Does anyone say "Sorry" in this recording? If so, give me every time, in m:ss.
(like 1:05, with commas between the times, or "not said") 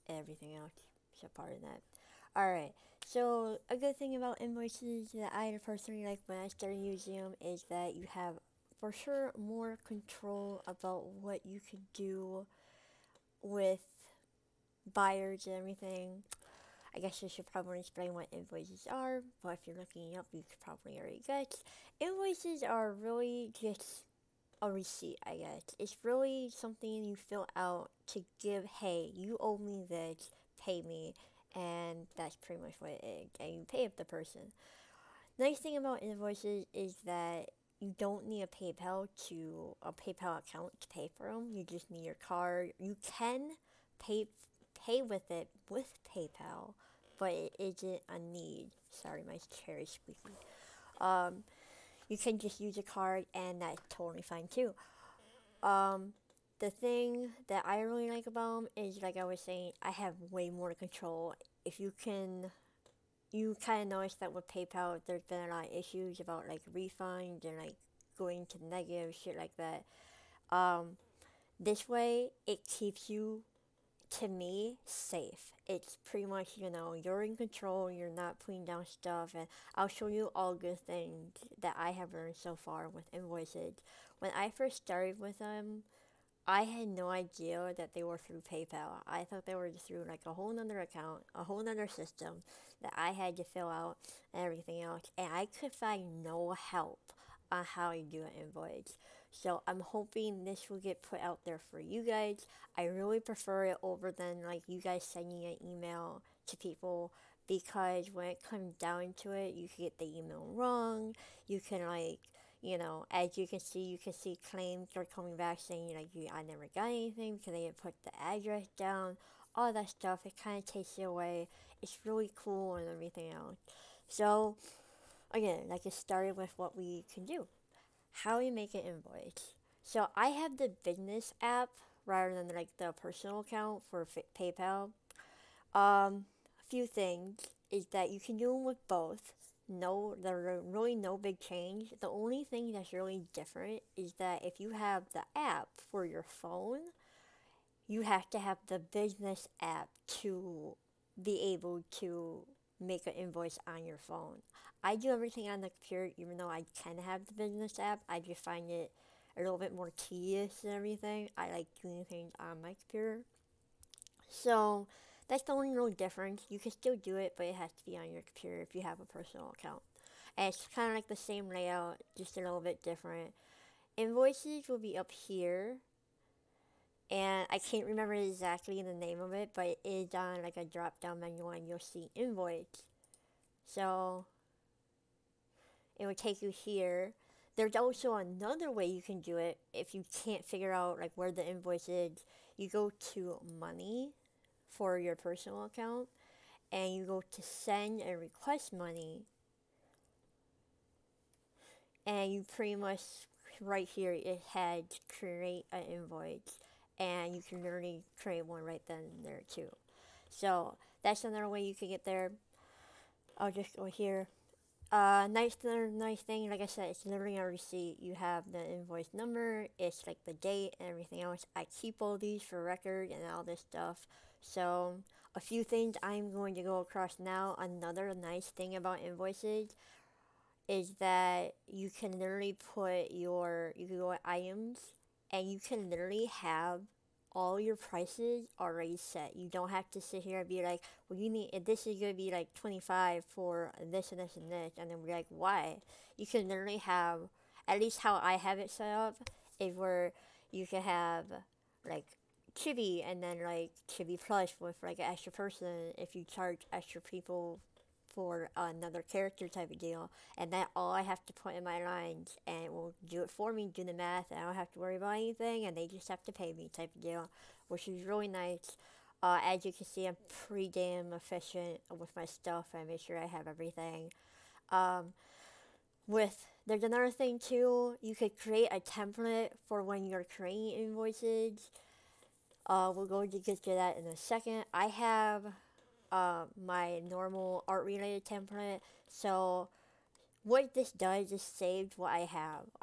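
0:48.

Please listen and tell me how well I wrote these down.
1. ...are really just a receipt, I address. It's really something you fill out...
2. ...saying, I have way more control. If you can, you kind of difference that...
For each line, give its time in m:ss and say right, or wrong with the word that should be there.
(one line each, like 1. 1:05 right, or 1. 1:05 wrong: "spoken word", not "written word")
1. 0:22 wrong: "guess", not "address"
2. 0:59 wrong: "notice", not "difference".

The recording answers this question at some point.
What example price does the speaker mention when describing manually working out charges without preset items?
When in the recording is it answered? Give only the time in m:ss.
4:02.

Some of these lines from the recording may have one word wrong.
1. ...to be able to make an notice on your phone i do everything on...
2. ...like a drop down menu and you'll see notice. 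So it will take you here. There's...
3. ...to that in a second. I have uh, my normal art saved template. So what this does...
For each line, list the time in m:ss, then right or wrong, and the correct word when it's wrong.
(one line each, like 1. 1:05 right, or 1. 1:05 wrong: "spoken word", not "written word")
1. 2:30 wrong: "invoice", not "notice"
2. 3:00 wrong: "invoice", not "notice"
3. 4:43 wrong: "related", not "saved".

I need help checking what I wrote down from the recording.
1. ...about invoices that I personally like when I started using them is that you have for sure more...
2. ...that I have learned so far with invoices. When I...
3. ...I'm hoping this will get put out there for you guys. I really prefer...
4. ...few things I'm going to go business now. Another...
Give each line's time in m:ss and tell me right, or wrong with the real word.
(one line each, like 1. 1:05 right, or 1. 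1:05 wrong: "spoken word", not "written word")
1. 0:04 right
2. 1:21 right
3. 1:39 right
4. 3:45 wrong: "across", not "business".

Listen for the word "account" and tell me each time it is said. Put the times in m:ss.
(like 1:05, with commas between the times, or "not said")
0:40, 1:30, 2:13, 2:49, 3:15.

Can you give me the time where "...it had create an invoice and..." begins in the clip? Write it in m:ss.
3:24.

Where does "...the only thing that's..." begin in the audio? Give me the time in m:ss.
2:21.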